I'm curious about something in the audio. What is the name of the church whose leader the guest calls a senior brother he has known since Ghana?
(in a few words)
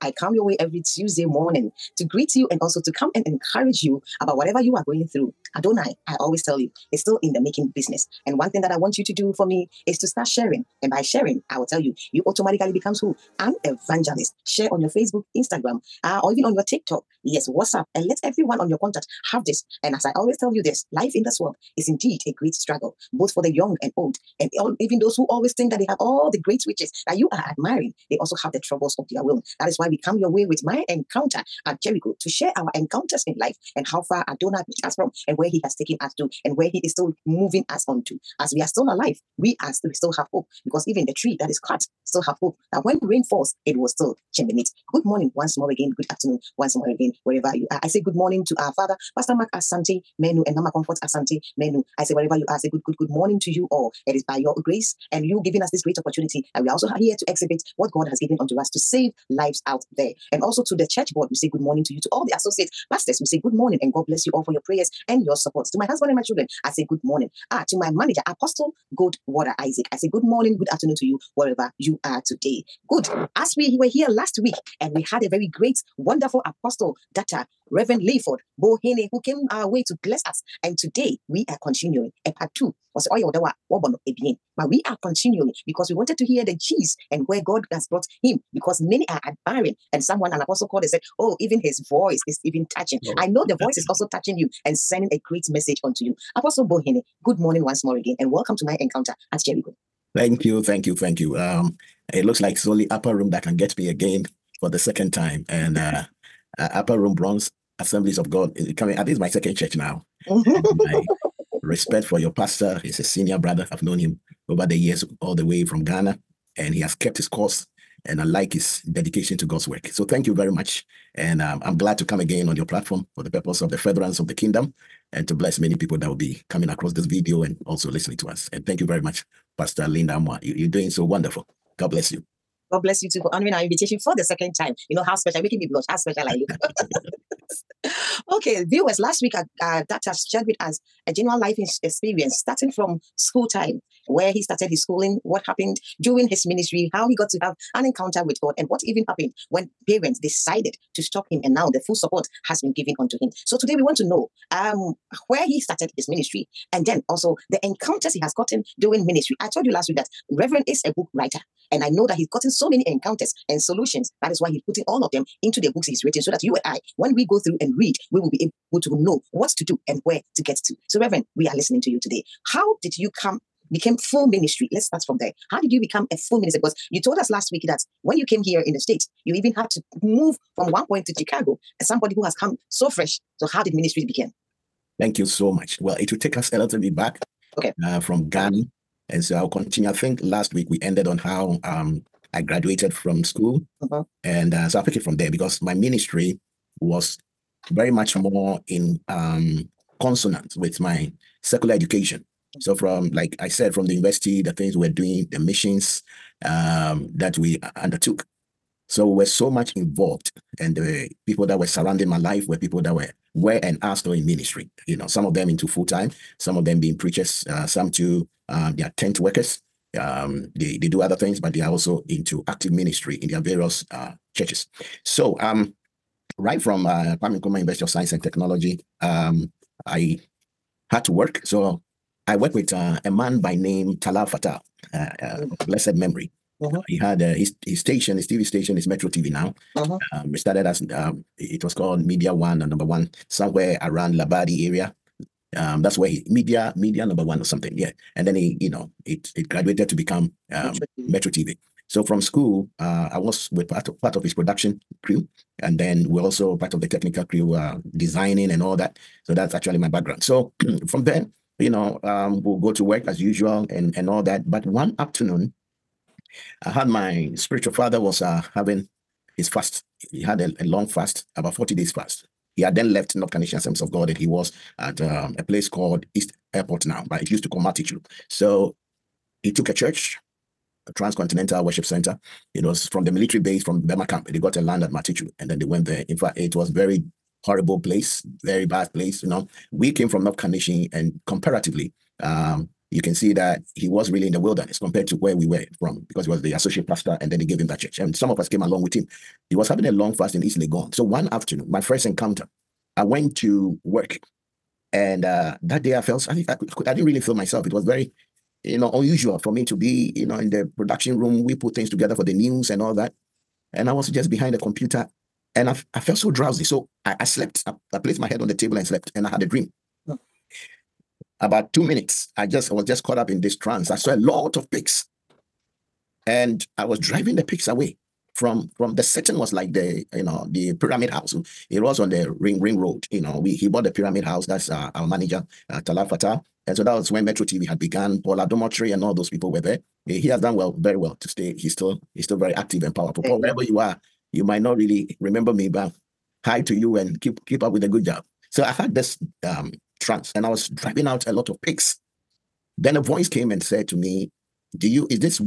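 Upper Room Bronx Assemblies of God.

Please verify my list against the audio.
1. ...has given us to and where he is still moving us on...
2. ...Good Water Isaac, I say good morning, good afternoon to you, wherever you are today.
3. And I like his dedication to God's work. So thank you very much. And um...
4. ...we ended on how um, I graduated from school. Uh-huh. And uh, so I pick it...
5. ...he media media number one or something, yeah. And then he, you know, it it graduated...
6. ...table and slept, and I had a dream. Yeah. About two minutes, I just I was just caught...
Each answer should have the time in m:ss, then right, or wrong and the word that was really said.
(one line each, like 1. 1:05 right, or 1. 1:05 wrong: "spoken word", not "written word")
1. 0:35 wrong: "taken", not "given"
2. 1:08 right
3. 1:58 right
4. 3:10 right
5. 4:06 right
6. 5:18 right.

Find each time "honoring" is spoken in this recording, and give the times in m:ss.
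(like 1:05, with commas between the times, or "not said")
2:13.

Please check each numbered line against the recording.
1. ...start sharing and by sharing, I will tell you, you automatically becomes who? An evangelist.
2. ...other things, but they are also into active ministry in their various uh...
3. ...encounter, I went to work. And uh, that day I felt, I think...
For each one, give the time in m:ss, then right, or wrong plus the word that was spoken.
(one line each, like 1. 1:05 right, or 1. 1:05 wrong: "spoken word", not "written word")
1. 0:10 right
2. 3:40 right
3. 5:02 right.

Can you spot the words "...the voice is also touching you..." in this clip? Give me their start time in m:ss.
1:33.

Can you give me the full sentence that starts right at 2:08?
And thank you very much, Pastor Linda Amoah.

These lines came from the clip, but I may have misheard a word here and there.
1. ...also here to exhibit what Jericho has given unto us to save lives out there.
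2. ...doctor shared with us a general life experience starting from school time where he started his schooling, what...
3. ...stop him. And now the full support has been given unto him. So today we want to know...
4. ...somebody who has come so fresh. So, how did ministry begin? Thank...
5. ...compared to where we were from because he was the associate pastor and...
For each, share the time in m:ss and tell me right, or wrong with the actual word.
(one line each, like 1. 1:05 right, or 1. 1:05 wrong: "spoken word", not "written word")
1. 0:56 wrong: "God", not "Jericho"
2. 2:19 right
3. 2:31 right
4. 3:01 right
5. 4:54 right.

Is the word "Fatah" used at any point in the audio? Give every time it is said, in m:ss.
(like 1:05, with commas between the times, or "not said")
3:54, 5:36.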